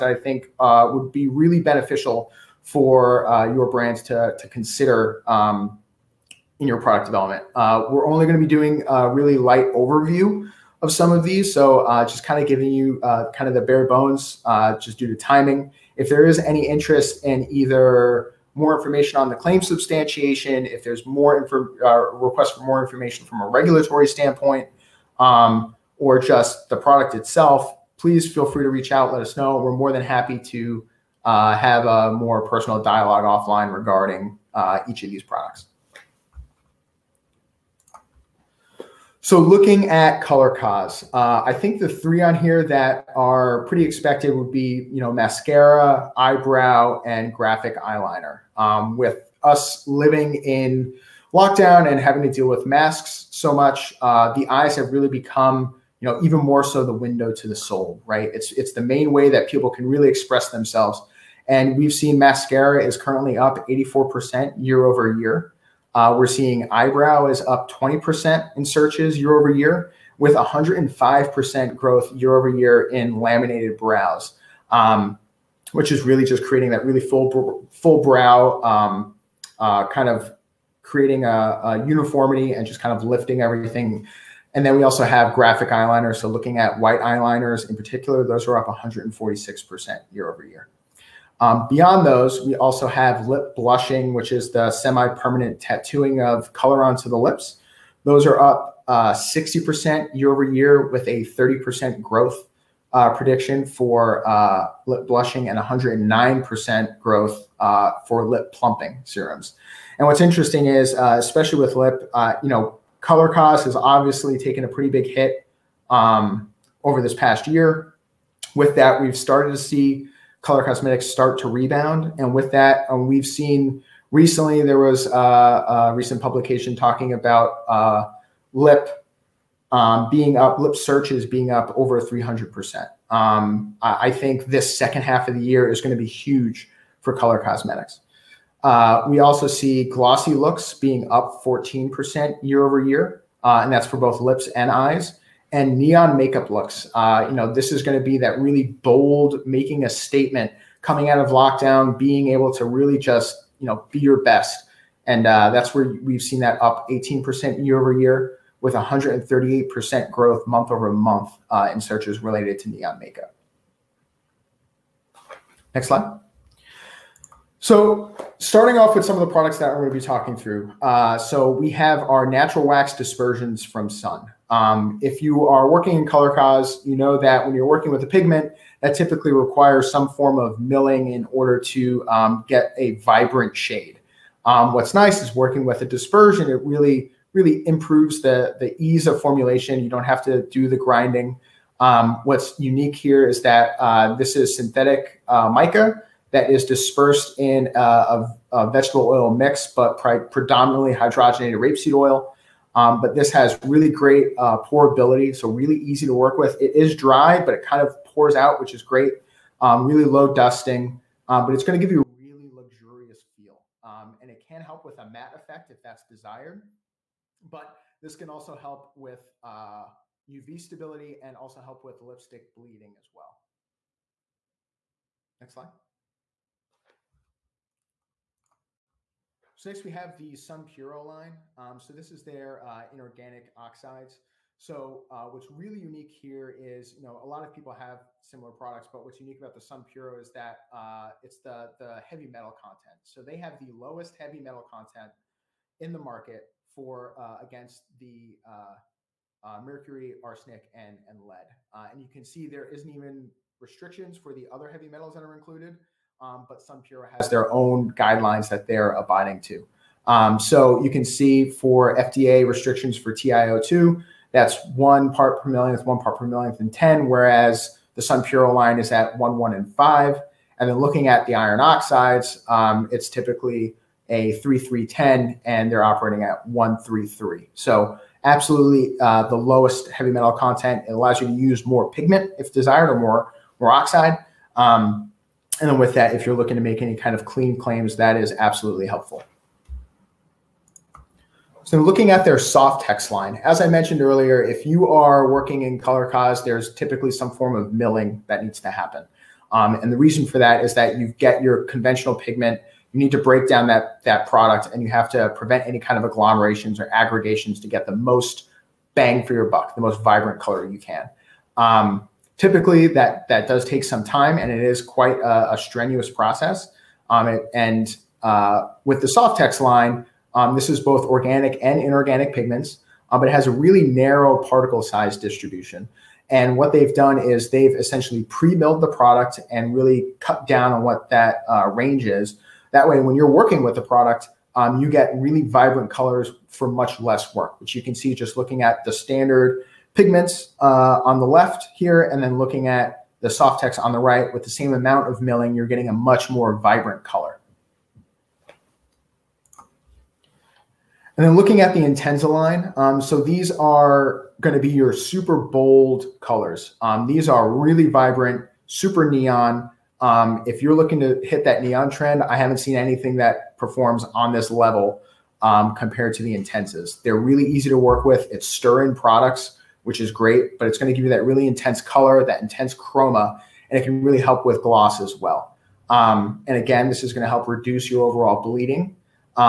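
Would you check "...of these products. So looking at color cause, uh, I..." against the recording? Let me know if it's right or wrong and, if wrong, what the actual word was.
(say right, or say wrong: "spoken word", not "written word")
right.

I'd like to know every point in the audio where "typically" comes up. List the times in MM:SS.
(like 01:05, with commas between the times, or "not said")
02:58, 04:33, 04:56, 05:12.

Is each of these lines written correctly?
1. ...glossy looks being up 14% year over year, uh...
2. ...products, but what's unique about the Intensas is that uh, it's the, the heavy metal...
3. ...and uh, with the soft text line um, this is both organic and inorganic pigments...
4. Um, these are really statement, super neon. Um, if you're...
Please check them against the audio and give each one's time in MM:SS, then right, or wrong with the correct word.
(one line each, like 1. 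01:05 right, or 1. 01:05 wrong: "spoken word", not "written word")
1. 02:19 right
2. 03:58 wrong: "Puro", not "Intensas"
3. 05:17 right
4. 05:56 wrong: "vibrant", not "statement".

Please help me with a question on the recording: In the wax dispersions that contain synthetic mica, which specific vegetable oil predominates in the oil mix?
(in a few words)
hydrogenated rapeseed oil.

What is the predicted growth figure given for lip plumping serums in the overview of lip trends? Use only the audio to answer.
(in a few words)
109%.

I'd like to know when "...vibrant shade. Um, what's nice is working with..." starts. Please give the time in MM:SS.
03:02.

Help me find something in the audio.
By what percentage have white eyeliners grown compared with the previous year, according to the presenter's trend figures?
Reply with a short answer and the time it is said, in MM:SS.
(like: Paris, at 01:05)
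146%, at 01:28.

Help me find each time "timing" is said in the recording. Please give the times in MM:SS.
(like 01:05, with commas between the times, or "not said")
00:15.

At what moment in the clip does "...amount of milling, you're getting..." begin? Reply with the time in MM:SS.
05:44.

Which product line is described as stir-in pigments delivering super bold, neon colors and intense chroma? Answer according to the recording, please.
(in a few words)
Intensa.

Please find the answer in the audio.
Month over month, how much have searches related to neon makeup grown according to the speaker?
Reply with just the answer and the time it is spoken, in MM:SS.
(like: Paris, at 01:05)
138%, at 02:38.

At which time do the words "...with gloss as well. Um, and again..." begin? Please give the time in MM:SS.
06:14.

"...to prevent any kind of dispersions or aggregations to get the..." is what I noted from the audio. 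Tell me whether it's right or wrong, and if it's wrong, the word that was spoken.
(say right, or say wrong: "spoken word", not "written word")
wrong: "agglomerations", not "dispersions".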